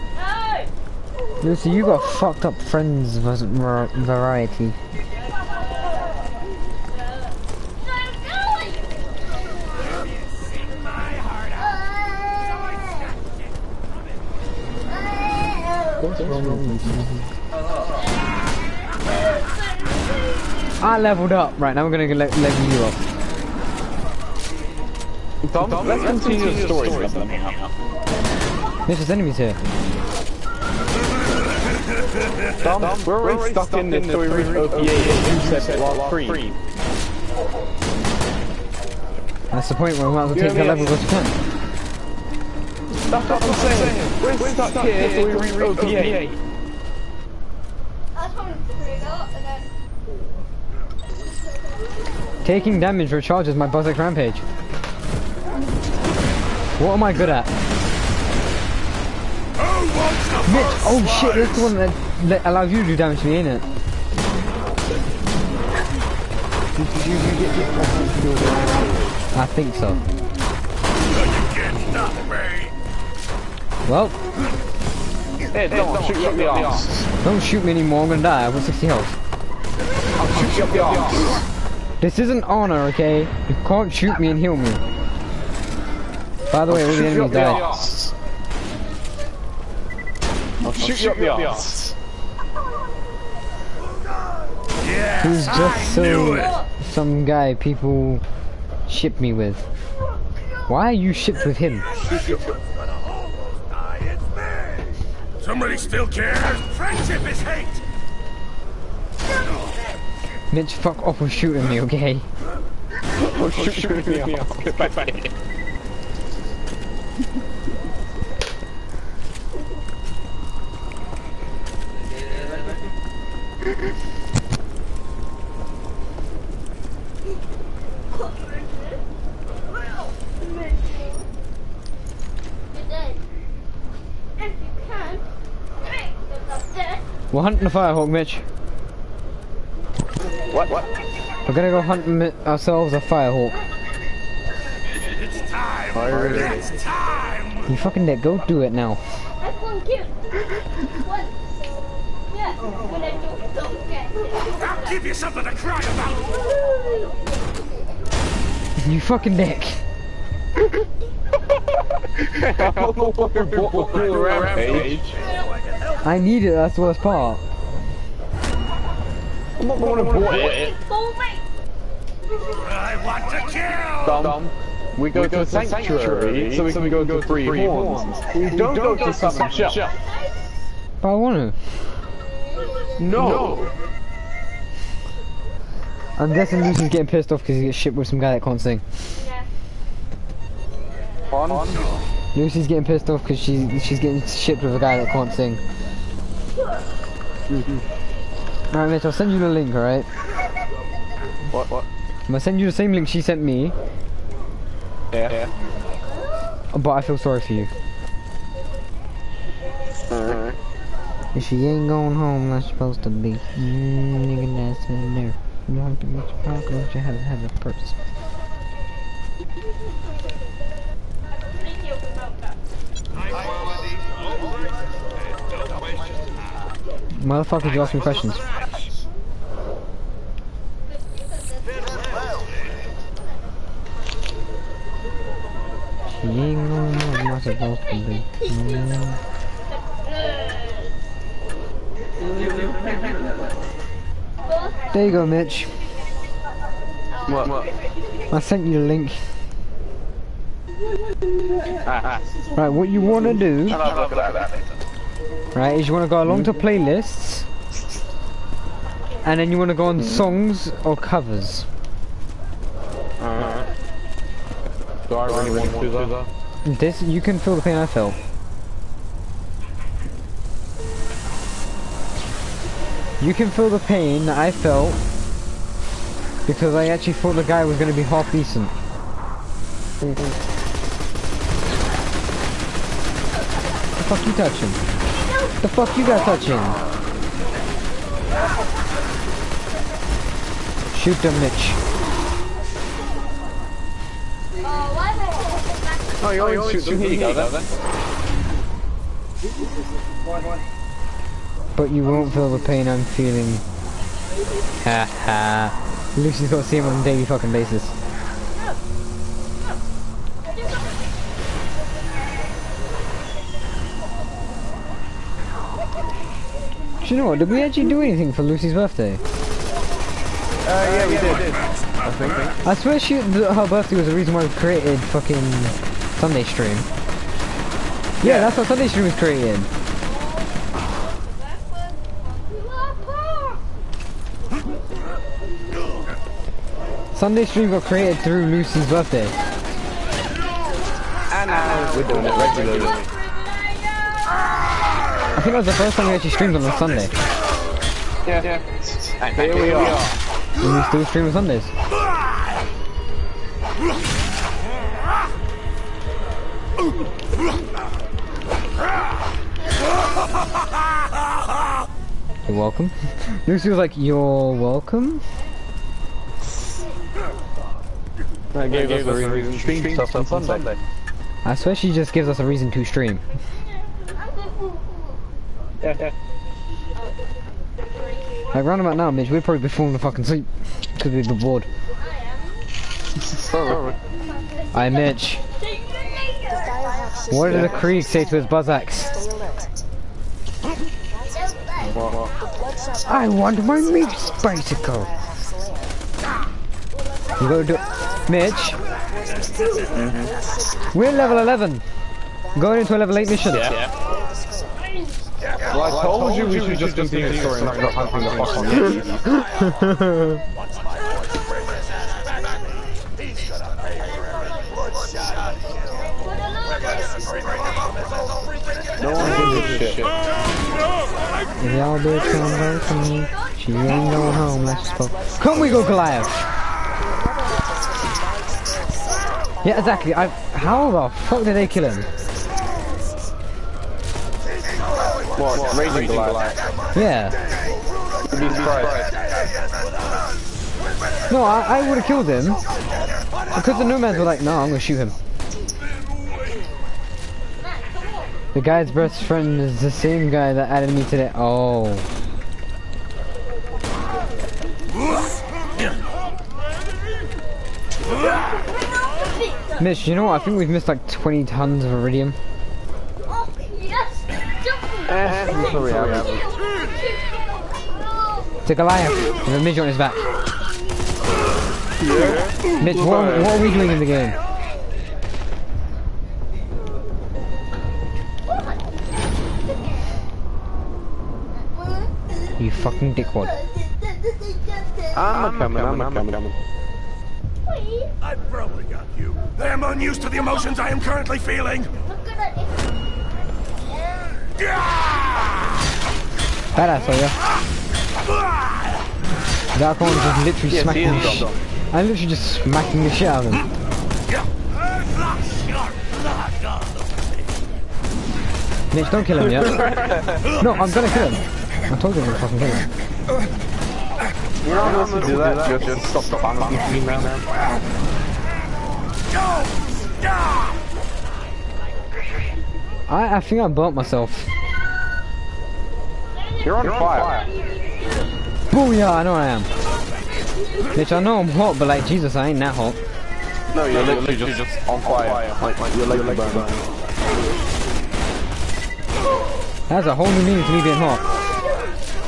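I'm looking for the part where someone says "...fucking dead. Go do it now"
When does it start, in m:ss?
2:27.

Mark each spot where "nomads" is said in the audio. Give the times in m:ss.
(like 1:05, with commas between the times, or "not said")
7:23.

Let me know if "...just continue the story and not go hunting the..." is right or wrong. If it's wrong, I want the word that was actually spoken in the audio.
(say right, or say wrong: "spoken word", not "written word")
right.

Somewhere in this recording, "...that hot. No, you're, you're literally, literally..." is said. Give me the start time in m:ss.
8:52.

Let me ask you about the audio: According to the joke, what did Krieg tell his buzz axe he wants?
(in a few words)
Meat bicycle.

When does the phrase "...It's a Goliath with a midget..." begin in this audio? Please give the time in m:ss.
7:48.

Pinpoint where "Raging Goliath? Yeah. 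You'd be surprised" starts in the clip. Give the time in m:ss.
7:15.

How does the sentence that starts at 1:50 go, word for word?
Bitch, fuck off with shooting me, okay?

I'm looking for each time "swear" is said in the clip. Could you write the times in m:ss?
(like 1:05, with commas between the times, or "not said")
5:22, 6:11.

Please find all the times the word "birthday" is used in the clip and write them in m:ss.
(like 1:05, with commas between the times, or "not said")
5:18, 5:23, 5:38.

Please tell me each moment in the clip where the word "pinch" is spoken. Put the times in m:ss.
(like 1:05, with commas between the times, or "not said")
not said.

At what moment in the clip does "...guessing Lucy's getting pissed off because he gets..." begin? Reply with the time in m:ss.
3:06.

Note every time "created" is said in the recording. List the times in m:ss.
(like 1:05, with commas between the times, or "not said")
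5:24, 5:29, 5:37.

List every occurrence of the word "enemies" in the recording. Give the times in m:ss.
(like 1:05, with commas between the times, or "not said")
0:29, 1:27.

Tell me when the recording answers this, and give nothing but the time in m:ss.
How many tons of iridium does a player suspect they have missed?
7:41.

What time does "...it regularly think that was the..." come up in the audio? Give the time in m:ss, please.
5:42.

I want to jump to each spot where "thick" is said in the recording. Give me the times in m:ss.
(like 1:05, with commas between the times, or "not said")
not said.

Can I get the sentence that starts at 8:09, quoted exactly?
I am unused to the emotions I am currently feeling.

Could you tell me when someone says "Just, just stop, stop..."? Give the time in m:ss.
8:35.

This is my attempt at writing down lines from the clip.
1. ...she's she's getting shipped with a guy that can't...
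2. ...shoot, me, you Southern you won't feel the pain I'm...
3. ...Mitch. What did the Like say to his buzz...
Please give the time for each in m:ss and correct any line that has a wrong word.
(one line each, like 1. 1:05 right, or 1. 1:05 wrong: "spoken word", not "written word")
1. 3:13 right
2. 4:56 wrong: "But", not "Southern"
3. 6:24 wrong: "Krieg", not "Like".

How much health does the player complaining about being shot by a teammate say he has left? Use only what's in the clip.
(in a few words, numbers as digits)
60.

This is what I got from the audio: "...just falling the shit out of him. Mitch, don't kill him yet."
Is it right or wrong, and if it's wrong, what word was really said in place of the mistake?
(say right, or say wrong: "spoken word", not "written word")
wrong: "smacking", not "falling".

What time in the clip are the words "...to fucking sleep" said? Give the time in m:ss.
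6:19.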